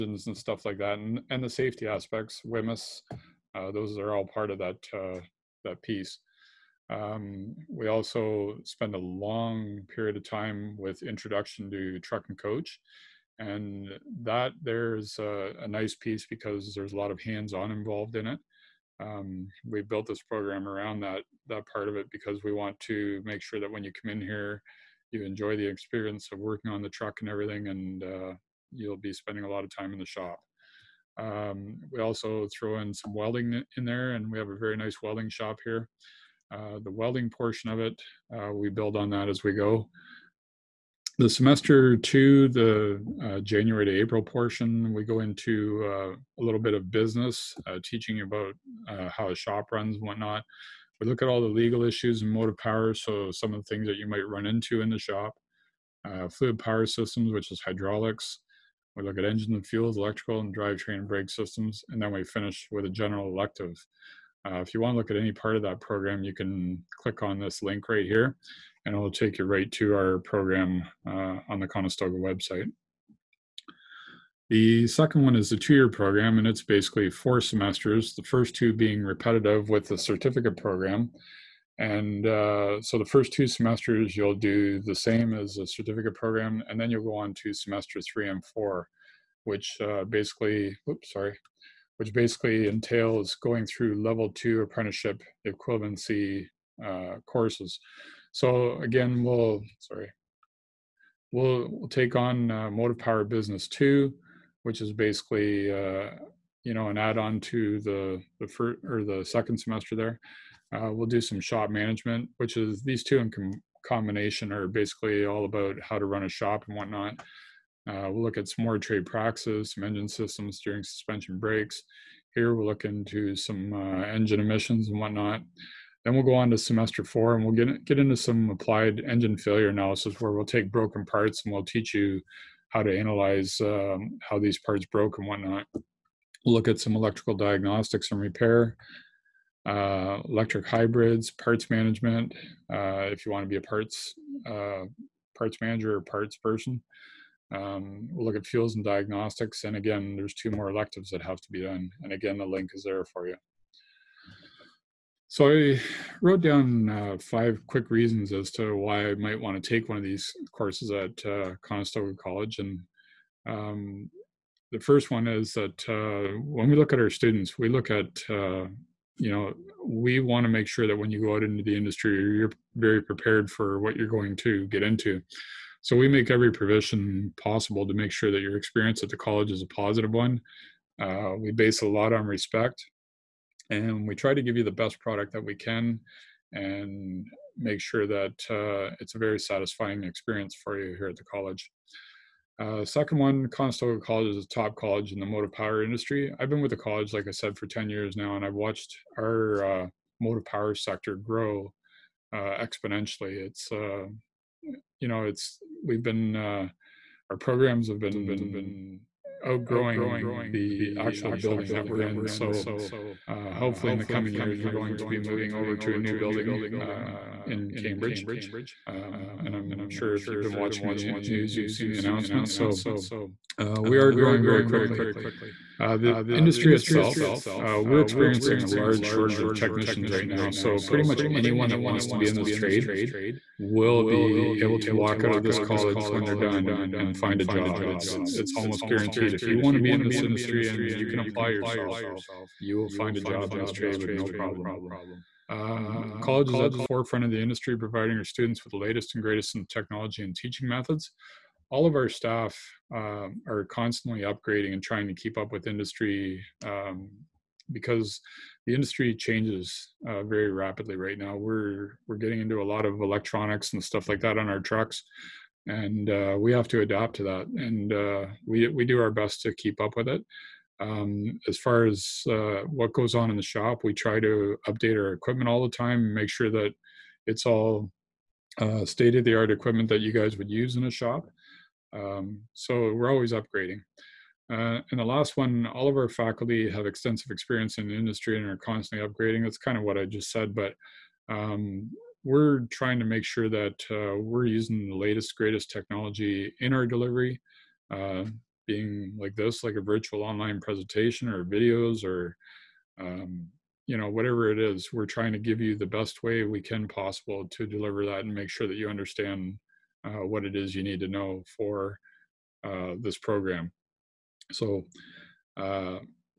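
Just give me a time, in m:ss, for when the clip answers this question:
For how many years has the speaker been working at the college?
3:17.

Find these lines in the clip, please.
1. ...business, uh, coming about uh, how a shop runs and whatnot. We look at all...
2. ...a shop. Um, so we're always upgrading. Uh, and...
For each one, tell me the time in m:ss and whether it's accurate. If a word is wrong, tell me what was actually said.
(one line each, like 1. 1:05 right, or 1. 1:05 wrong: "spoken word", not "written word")
1. 0:46 wrong: "teaching", not "coming"
2. 4:40 right.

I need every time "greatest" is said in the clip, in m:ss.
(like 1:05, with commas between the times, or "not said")
4:09, 4:55.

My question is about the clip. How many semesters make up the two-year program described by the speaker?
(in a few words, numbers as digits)
4.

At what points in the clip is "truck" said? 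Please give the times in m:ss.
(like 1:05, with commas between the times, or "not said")
0:11, 0:26, 4:24.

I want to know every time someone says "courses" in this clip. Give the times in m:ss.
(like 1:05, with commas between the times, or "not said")
1:37, 2:40.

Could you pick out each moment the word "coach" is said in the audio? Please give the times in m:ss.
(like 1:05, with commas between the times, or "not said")
0:12.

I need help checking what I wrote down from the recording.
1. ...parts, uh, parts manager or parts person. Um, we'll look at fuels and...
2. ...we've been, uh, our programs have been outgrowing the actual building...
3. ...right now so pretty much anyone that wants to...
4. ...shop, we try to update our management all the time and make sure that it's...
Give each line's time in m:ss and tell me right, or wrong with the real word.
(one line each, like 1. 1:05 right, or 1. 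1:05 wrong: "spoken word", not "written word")
1. 2:23 right
2. 3:25 right
3. 3:50 right
4. 4:33 wrong: "equipment", not "management".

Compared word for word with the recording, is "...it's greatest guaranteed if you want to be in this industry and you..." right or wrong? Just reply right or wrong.
wrong.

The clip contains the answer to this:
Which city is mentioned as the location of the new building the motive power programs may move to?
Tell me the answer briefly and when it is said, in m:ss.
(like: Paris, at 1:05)
Cambridge, at 3:37.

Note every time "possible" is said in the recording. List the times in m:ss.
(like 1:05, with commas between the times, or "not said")
2:57, 5:06.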